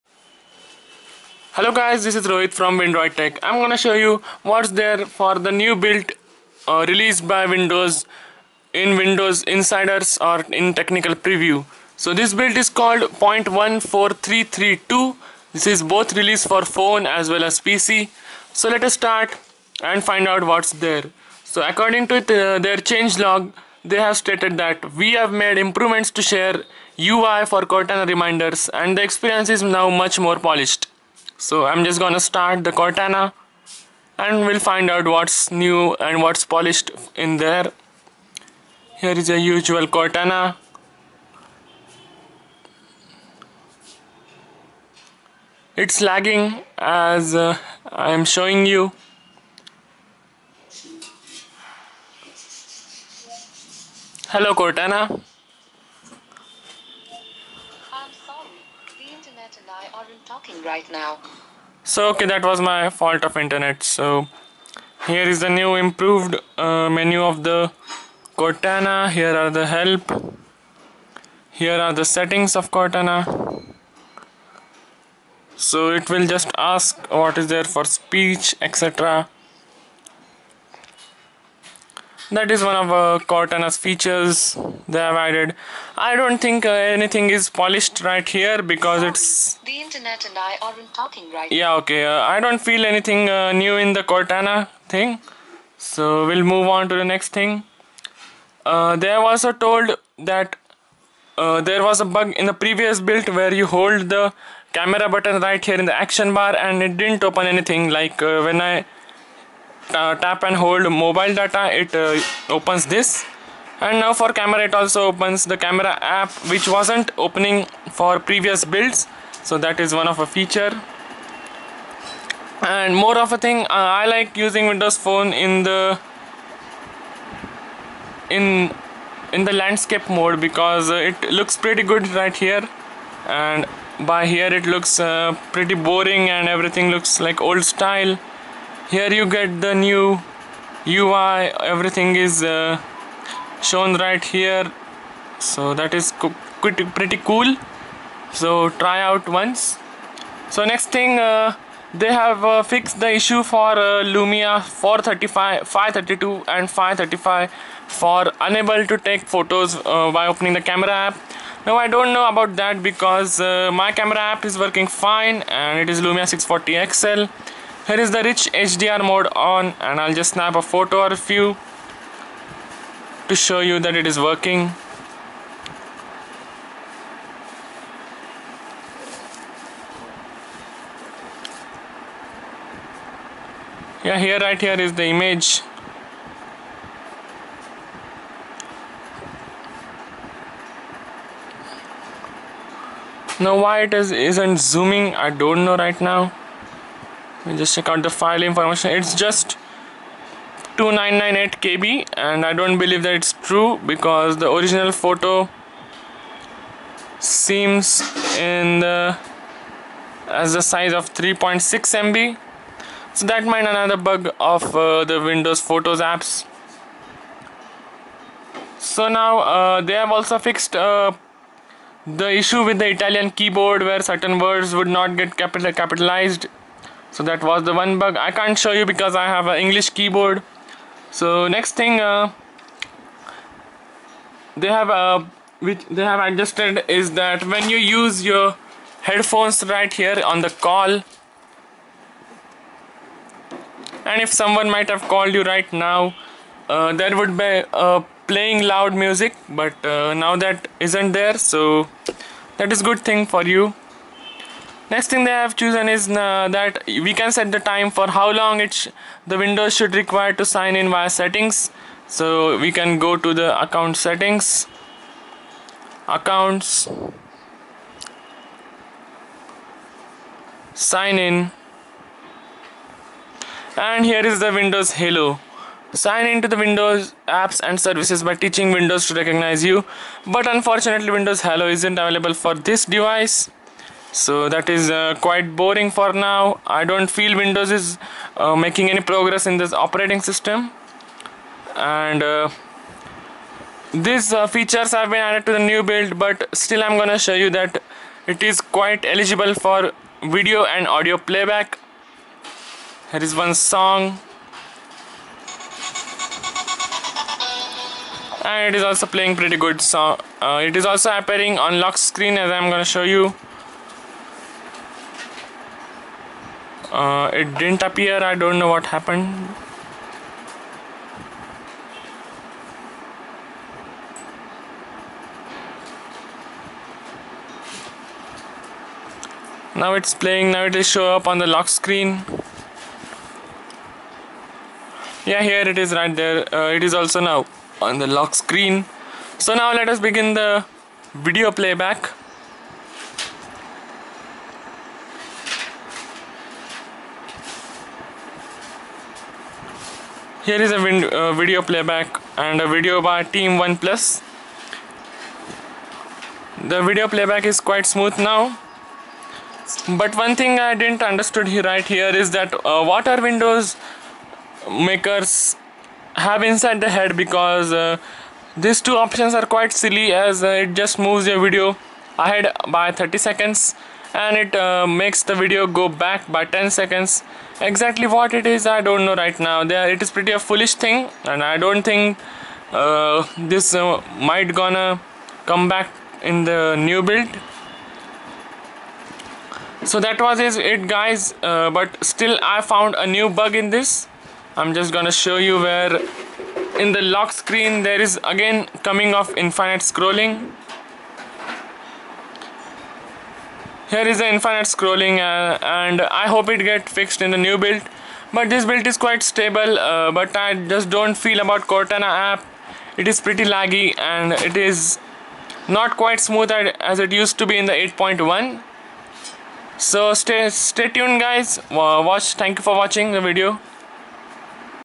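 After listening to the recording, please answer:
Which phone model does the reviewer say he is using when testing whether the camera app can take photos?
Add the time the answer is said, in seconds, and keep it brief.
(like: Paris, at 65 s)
Lumia 640 XL, at 166 s.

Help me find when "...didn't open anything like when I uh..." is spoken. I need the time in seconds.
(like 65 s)
106 s.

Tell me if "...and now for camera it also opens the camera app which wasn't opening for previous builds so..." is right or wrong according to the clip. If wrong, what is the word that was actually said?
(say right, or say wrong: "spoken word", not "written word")
right.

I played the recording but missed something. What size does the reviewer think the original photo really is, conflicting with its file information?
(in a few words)
3.6 MB.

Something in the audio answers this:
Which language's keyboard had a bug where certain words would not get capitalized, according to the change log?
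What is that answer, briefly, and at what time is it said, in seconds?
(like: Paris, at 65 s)
Italian, at 222 s.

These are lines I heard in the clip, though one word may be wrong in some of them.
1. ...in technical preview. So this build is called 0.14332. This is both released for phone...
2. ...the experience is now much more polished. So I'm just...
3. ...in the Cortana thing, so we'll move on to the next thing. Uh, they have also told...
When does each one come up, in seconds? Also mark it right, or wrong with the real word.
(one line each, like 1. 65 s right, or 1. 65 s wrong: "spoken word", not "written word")
1. 10 s right
2. 28 s right
3. 93 s right.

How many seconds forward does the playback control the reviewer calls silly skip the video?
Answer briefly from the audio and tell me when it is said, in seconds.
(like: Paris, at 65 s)
30, at 372 s.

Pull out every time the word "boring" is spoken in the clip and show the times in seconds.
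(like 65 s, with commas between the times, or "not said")
135 s, 285 s.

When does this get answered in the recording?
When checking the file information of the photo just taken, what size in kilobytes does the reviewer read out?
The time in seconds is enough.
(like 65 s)
200 s.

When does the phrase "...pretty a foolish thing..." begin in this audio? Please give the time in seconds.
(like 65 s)
380 s.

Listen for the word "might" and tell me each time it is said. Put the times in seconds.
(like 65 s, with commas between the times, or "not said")
213 s, 244 s, 384 s.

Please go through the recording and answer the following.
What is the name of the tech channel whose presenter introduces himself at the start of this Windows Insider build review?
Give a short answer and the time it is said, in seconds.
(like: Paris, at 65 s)
Windroid Tech, at 2 s.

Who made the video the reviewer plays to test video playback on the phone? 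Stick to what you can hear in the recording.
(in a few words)
Team One Plus.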